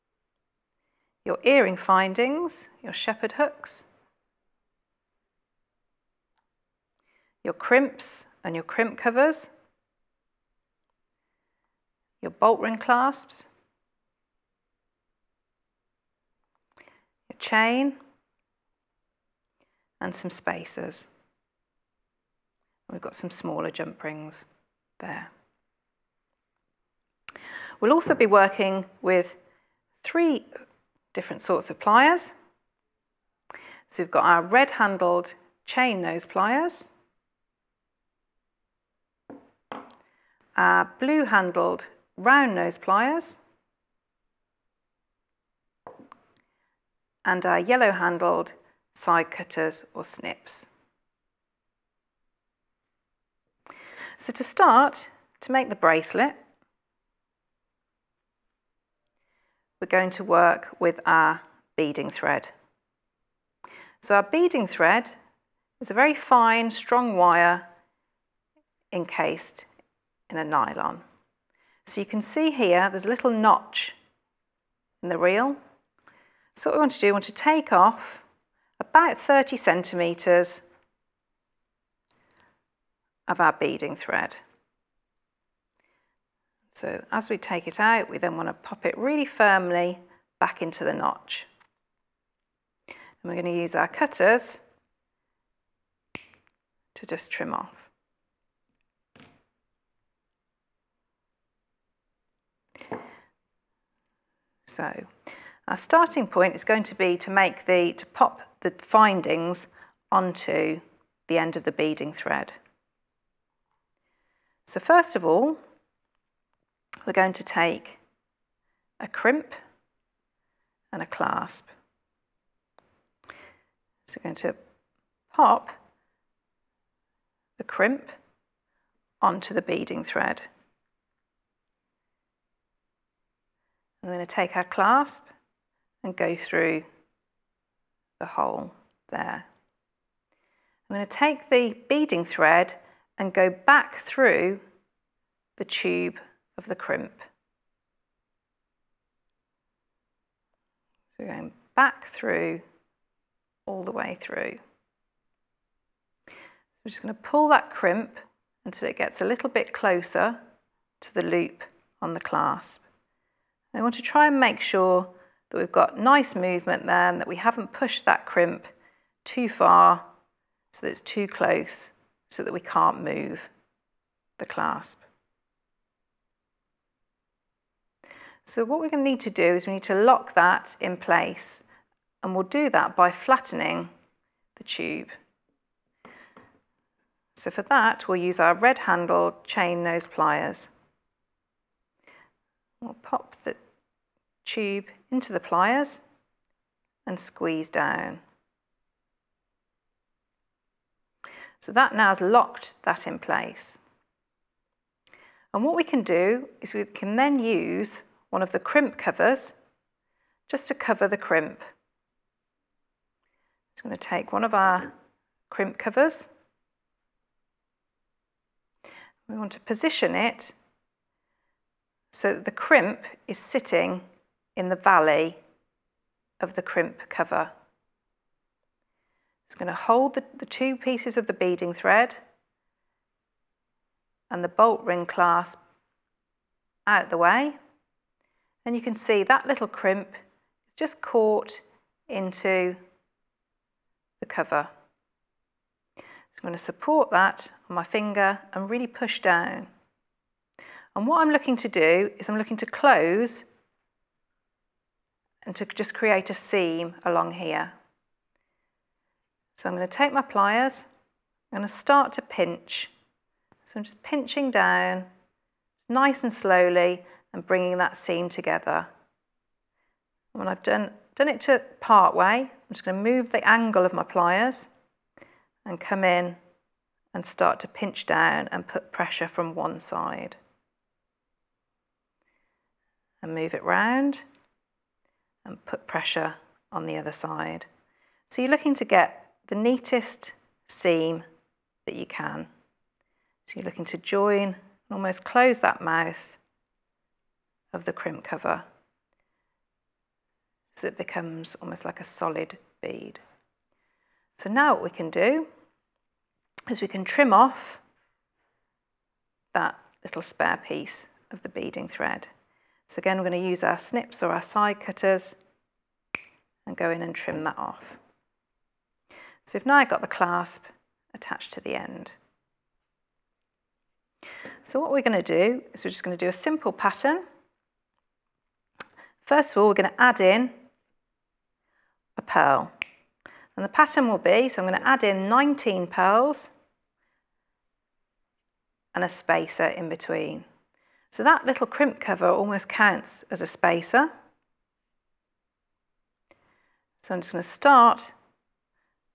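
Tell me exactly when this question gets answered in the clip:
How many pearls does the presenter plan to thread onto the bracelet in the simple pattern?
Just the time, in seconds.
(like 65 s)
335 s.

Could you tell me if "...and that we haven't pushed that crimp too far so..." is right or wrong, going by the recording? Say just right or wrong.
right.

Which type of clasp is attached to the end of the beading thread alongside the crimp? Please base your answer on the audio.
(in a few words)
Bolt ring clasp.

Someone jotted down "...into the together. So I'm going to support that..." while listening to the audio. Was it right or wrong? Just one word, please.
wrong.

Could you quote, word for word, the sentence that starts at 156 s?
So we're just going to pull that crimp until it gets a little bit closer to the loop on the clasp.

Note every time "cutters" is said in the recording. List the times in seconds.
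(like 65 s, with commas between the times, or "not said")
49 s, 93 s, 314 s.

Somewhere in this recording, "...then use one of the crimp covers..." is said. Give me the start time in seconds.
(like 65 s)
207 s.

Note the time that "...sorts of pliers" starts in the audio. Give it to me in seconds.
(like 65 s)
31 s.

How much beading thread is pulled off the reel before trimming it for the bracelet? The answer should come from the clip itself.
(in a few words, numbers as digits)
30 centimetres.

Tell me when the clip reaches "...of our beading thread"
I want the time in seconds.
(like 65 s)
83 s.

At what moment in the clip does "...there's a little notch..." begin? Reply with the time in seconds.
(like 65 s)
72 s.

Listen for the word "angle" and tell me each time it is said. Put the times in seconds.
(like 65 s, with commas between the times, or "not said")
273 s.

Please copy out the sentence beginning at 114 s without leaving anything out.
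So first of all, we're going to take a crimp and a clasp.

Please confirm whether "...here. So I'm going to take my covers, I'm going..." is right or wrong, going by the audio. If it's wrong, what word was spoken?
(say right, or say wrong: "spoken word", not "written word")
wrong: "pliers", not "covers".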